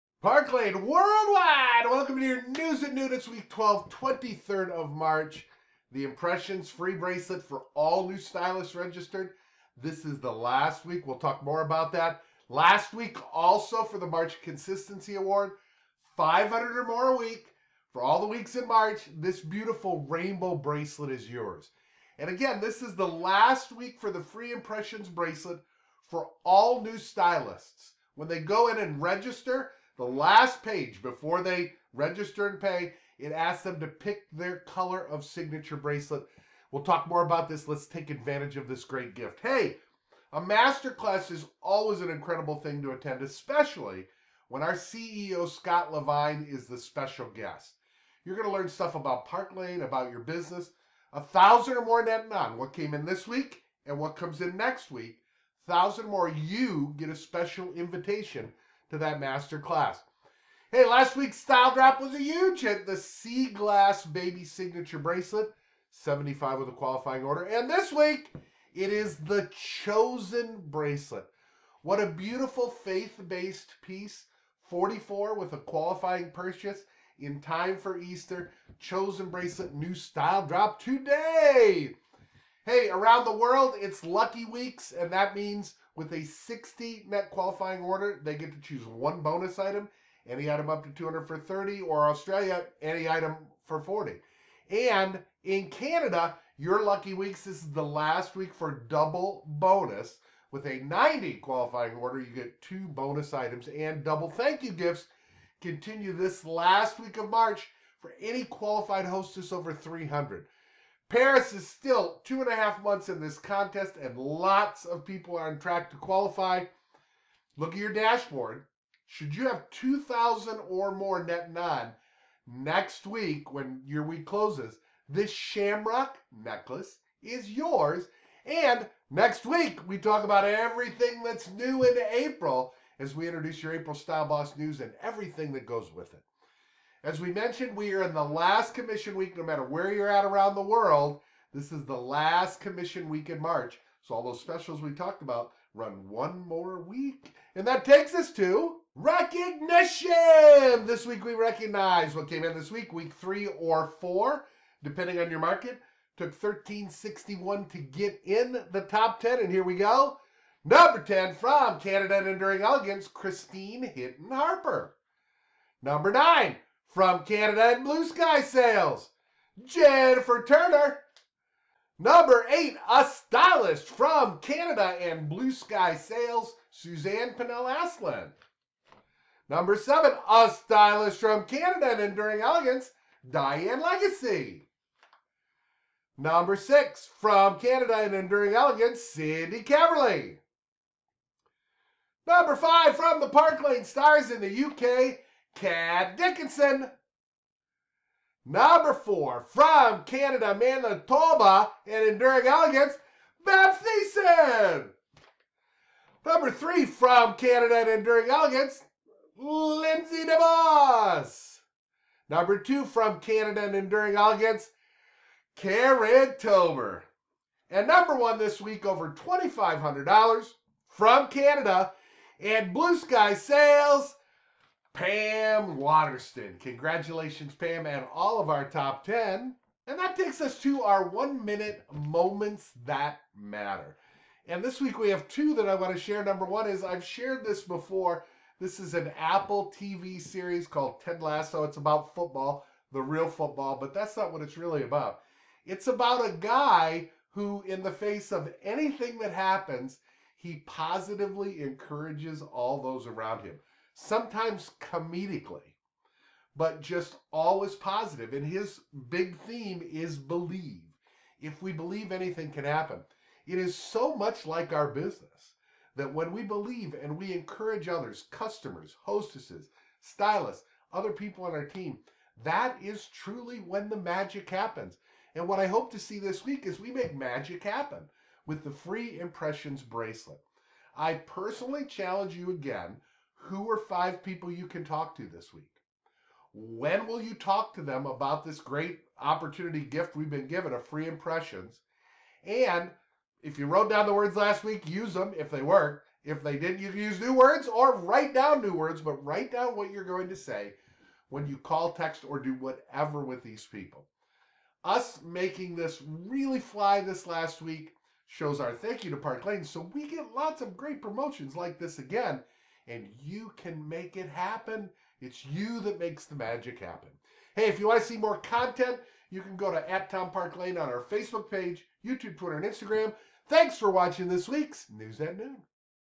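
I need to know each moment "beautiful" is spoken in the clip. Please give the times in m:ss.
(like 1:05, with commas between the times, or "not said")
0:19, 1:12.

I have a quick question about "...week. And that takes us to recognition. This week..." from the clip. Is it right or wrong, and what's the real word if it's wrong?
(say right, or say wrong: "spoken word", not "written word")
right.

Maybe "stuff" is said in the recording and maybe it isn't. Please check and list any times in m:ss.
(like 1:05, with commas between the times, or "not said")
0:48.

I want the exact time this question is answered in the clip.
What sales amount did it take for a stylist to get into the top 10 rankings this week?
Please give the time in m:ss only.
2:36.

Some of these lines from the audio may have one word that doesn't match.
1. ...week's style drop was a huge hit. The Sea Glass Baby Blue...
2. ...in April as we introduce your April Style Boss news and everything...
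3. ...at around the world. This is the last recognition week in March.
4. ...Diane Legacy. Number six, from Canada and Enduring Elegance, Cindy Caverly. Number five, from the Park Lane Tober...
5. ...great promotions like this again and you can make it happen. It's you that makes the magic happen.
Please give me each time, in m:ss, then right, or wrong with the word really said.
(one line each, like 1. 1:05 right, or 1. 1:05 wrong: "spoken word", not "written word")
1. 1:01 wrong: "Signature", not "Blue"
2. 2:11 right
3. 2:20 wrong: "commission", not "recognition"
4. 3:03 wrong: "Stars", not "Tober"
5. 5:10 right.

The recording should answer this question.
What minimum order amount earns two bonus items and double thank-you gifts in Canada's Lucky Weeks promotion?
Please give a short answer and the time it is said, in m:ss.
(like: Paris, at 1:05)
90, at 1:40.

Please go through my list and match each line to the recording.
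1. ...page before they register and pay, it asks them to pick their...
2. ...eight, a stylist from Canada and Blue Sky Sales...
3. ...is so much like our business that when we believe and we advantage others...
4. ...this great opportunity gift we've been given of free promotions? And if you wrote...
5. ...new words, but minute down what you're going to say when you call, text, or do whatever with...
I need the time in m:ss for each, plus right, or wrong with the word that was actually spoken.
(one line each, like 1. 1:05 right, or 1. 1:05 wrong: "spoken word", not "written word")
1. 0:30 right
2. 2:52 right
3. 4:23 wrong: "encourage", not "advantage"
4. 4:48 wrong: "impressions", not "promotions"
5. 4:58 wrong: "write", not "minute".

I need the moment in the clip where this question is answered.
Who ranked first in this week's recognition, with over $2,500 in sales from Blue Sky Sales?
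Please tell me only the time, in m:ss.
3:45.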